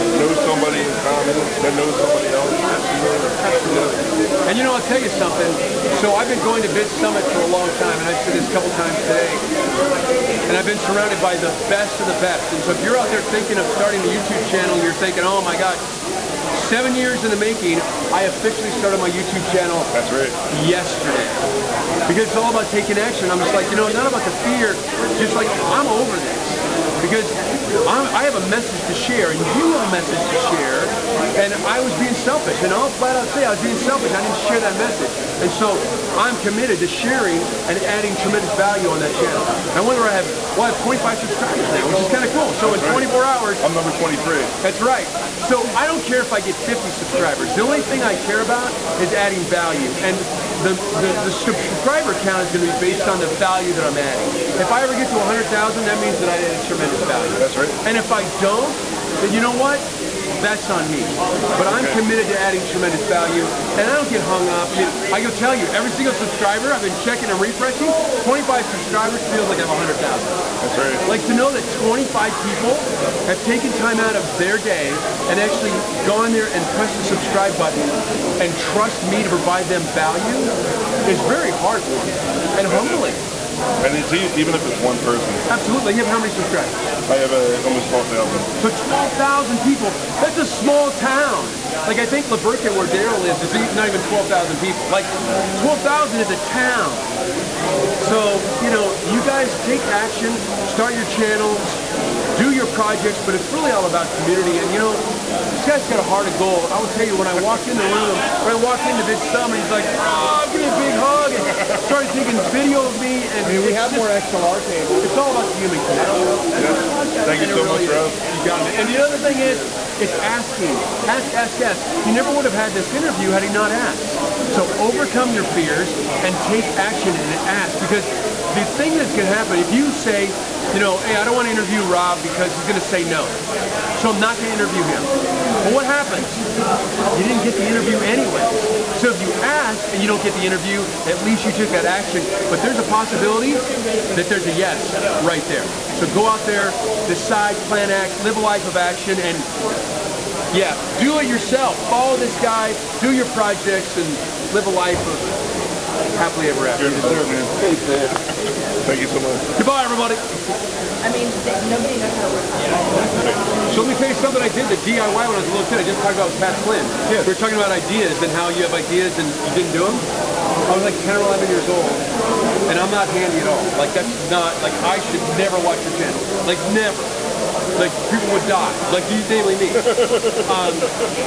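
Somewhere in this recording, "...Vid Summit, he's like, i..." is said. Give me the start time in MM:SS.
01:49.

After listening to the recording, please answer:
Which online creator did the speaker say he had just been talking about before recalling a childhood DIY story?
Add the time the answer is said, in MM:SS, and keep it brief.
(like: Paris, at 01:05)
Pat Flynn, at 02:46.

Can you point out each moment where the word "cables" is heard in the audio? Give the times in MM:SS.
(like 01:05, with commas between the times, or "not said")
01:54.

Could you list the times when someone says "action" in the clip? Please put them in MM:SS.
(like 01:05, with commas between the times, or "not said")
00:22, 01:39, 02:06, 02:21, 02:28.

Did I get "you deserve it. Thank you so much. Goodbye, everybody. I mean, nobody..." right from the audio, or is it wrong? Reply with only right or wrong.
right.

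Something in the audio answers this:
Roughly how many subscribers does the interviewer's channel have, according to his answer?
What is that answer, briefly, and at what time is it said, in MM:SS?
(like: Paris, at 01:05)
12,000, at 01:27.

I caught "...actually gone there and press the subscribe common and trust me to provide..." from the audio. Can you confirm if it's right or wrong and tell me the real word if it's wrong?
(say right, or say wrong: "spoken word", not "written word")
wrong: "button", not "common".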